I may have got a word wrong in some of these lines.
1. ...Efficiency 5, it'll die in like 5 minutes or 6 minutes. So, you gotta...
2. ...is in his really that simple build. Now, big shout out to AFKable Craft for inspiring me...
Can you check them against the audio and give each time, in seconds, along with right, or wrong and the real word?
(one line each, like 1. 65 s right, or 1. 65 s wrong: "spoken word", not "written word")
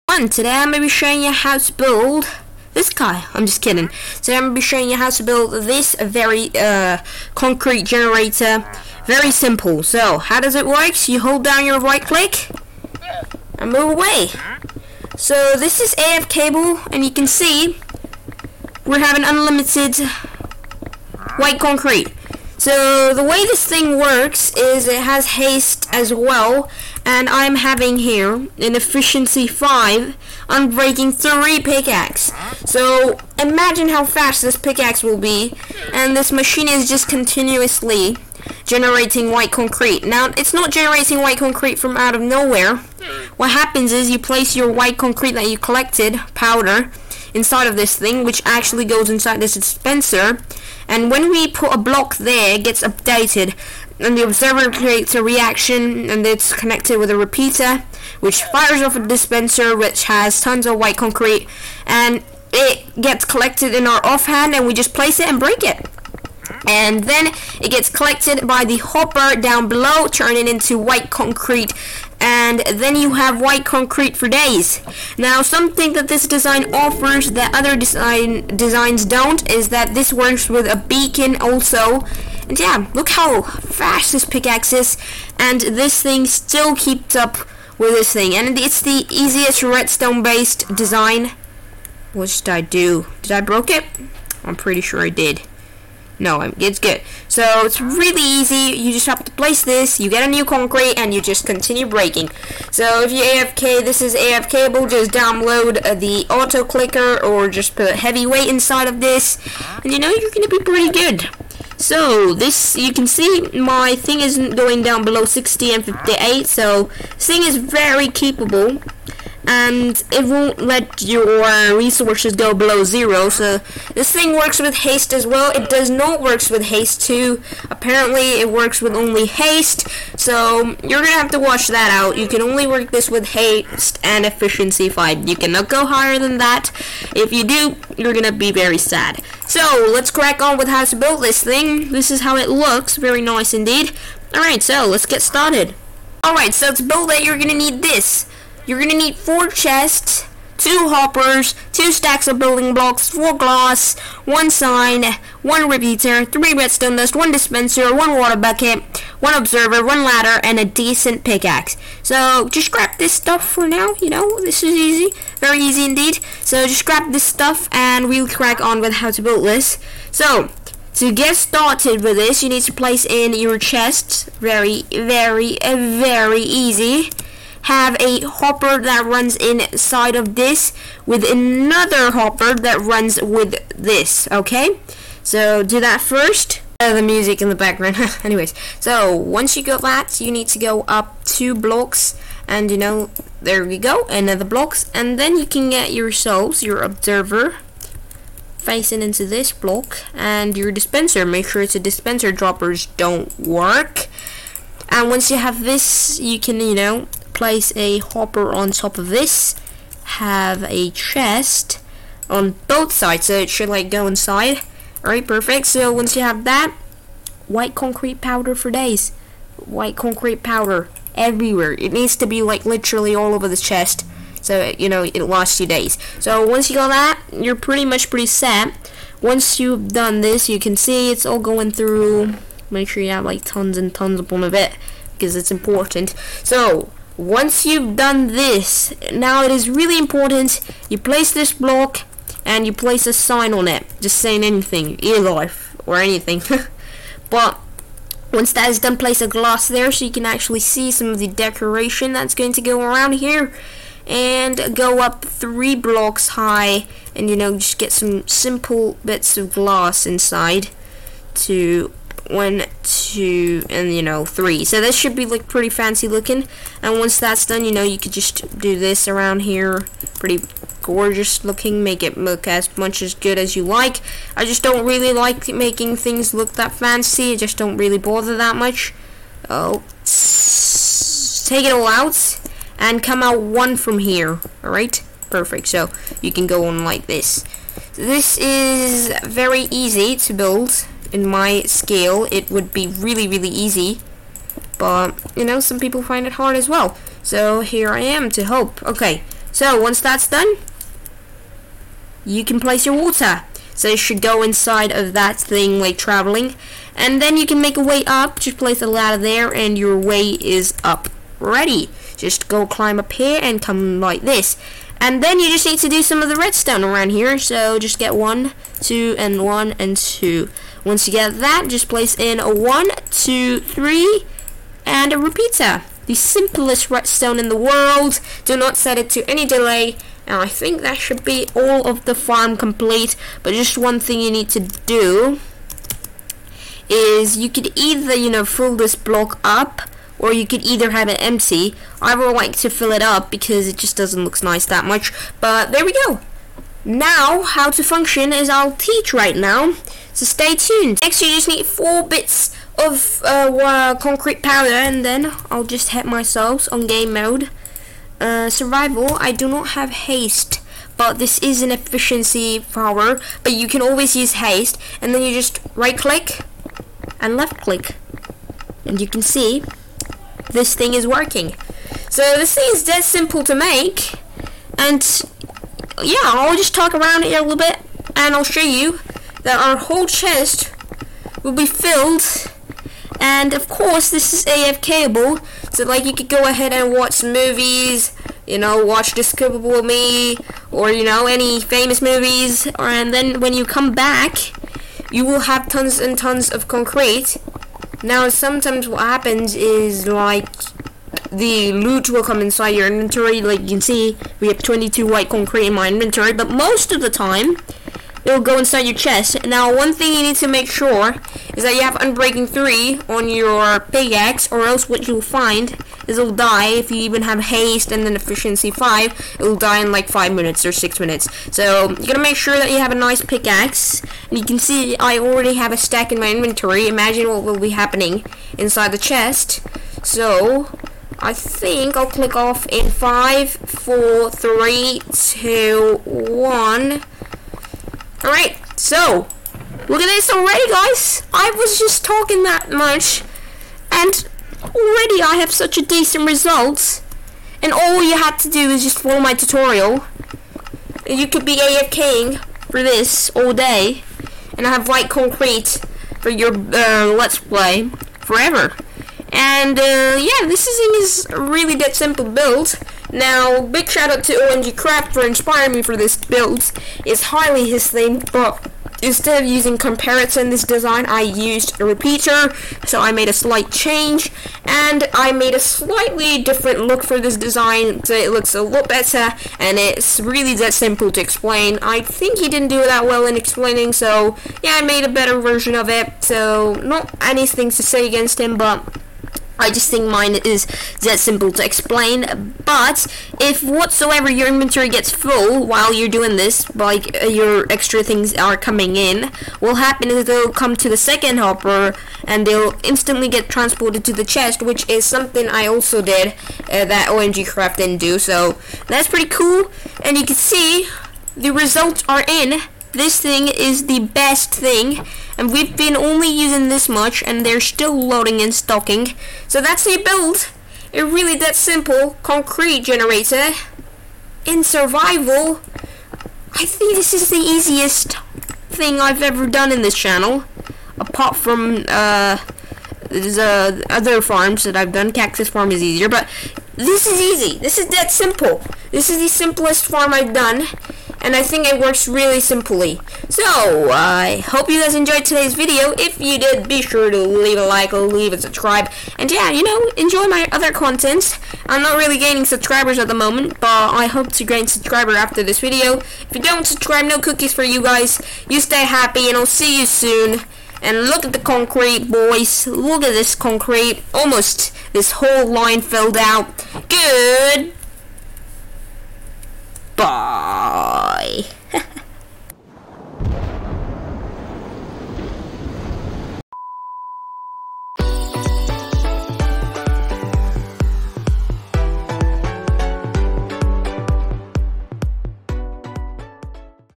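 1. 418 s right
2. 460 s wrong: "OMG", not "AFKable".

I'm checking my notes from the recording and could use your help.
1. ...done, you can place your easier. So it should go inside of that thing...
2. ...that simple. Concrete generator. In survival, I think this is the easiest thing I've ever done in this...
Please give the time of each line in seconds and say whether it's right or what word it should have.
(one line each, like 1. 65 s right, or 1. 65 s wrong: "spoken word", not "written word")
1. 300 s wrong: "water", not "easier"
2. 521 s right.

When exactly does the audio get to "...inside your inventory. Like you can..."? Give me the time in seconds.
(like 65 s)
402 s.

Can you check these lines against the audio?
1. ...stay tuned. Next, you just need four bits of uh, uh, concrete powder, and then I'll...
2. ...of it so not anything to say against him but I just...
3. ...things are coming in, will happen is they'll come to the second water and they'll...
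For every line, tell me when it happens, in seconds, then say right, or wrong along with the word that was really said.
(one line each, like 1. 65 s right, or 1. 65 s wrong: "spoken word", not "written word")
1. 350 s right
2. 485 s right
3. 498 s wrong: "hopper", not "water".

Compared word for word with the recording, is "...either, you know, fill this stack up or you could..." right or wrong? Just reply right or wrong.
wrong.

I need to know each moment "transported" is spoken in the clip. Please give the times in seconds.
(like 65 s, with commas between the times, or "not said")
503 s.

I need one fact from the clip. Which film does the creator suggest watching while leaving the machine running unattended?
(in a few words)
Despicable Me.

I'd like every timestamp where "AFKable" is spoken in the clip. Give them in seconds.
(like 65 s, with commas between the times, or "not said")
15 s, 104 s, 384 s.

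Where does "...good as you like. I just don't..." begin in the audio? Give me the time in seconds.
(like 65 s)
273 s.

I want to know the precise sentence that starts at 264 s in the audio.
So this should be like pretty fancy looking.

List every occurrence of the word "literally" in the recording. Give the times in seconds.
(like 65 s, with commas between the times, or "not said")
222 s.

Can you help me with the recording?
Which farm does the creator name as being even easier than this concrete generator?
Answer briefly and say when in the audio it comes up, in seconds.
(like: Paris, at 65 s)
Cactus farm, at 535 s.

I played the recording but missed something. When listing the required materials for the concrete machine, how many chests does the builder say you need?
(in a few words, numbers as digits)
4.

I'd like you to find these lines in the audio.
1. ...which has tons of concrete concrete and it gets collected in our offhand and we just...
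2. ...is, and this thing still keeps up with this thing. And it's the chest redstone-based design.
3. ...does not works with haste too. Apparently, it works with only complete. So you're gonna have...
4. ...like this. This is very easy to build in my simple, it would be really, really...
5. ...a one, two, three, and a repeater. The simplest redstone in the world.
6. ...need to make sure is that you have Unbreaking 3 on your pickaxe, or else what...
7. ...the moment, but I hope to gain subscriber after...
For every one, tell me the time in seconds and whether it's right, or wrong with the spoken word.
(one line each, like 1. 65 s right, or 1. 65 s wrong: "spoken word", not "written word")
1. 59 s wrong: "white", not "concrete"
2. 84 s wrong: "easiest", not "chest"
3. 125 s wrong: "haste", not "complete"
4. 286 s wrong: "scale", not "simple"
5. 322 s right
6. 410 s right
7. 553 s right.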